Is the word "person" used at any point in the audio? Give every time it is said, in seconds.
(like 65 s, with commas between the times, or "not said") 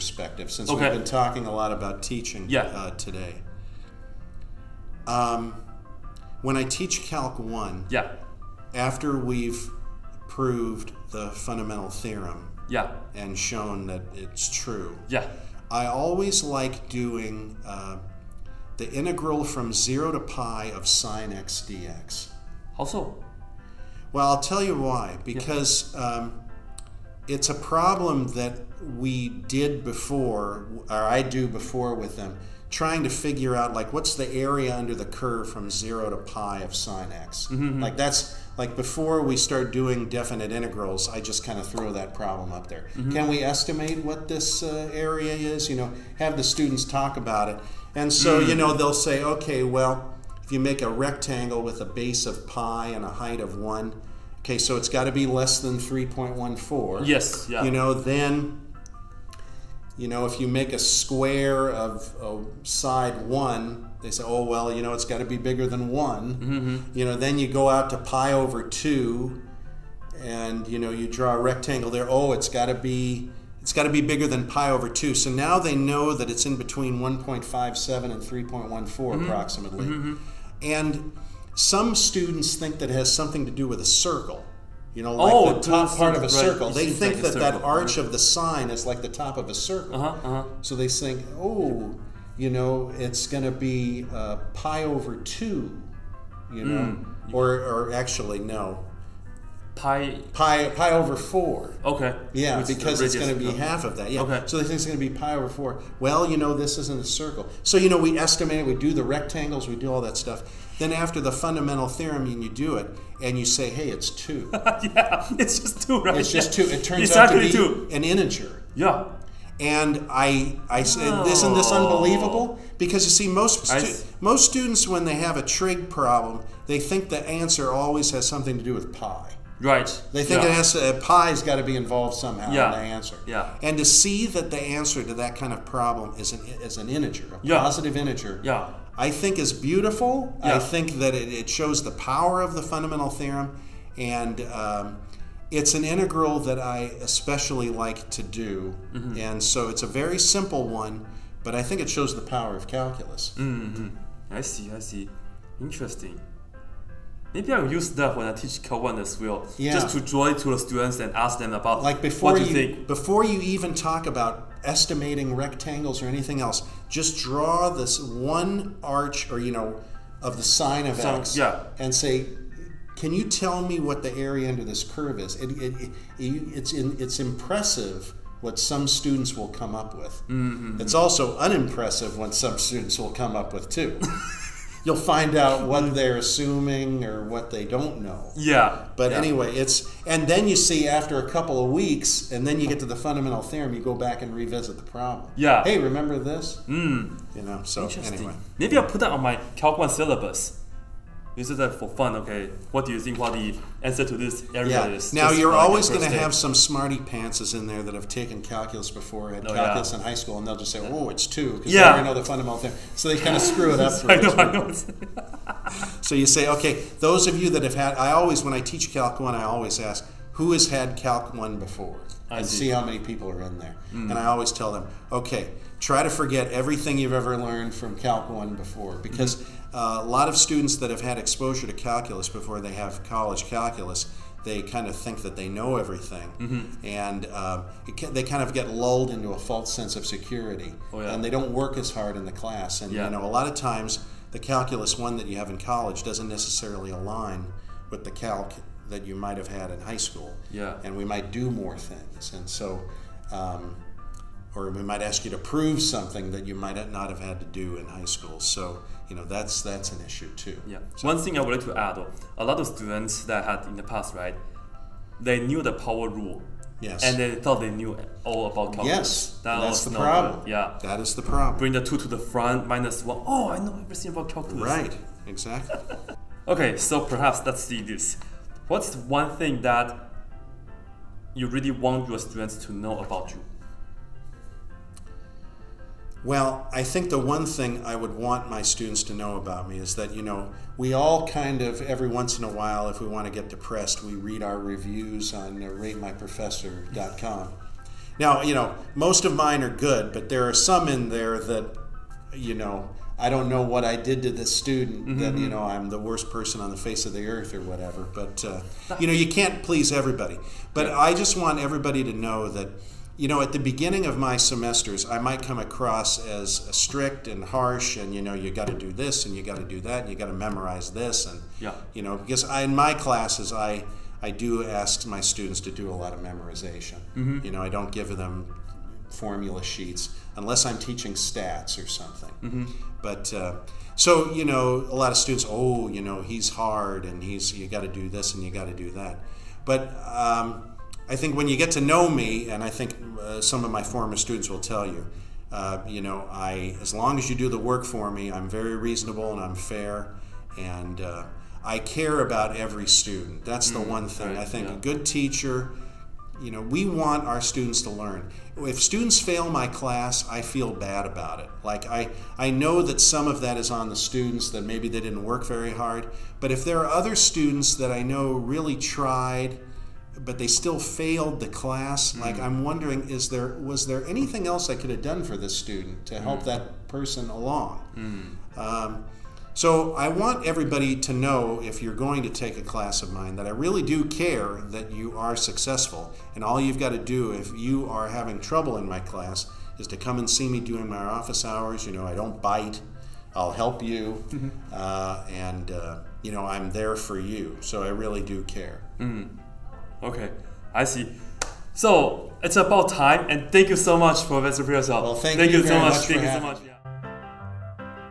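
306 s, 376 s.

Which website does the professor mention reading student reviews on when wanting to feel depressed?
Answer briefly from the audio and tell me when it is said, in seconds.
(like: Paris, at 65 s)
ratemyprofessor.com, at 295 s.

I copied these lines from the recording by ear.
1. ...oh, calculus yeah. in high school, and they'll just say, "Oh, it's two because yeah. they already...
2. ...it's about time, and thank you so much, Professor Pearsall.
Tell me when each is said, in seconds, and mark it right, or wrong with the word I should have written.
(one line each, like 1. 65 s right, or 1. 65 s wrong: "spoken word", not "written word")
1. 209 s right
2. 402 s right.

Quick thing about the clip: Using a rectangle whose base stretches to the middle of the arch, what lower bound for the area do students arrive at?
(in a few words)
pi over 2.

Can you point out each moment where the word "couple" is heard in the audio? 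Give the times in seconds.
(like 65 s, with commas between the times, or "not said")
191 s.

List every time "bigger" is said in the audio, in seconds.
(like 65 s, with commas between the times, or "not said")
65 s, 73 s.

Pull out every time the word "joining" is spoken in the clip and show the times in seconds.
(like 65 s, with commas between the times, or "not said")
not said.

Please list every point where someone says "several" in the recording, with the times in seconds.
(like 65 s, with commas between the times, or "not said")
not said.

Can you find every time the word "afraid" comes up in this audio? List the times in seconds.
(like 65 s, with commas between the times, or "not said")
not said.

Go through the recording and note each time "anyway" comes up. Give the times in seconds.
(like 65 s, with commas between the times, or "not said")
189 s, 198 s.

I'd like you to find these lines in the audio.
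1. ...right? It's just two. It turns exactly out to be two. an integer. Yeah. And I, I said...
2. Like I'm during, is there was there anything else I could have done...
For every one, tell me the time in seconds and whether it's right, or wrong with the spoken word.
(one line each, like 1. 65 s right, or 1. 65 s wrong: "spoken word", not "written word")
1. 116 s right
2. 372 s wrong: "wondering", not "during".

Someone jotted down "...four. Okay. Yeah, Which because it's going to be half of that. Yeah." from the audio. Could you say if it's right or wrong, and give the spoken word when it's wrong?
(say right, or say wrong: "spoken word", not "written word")
right.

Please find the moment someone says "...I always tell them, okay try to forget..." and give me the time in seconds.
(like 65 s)
224 s.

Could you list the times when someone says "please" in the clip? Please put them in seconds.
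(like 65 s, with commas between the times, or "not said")
309 s.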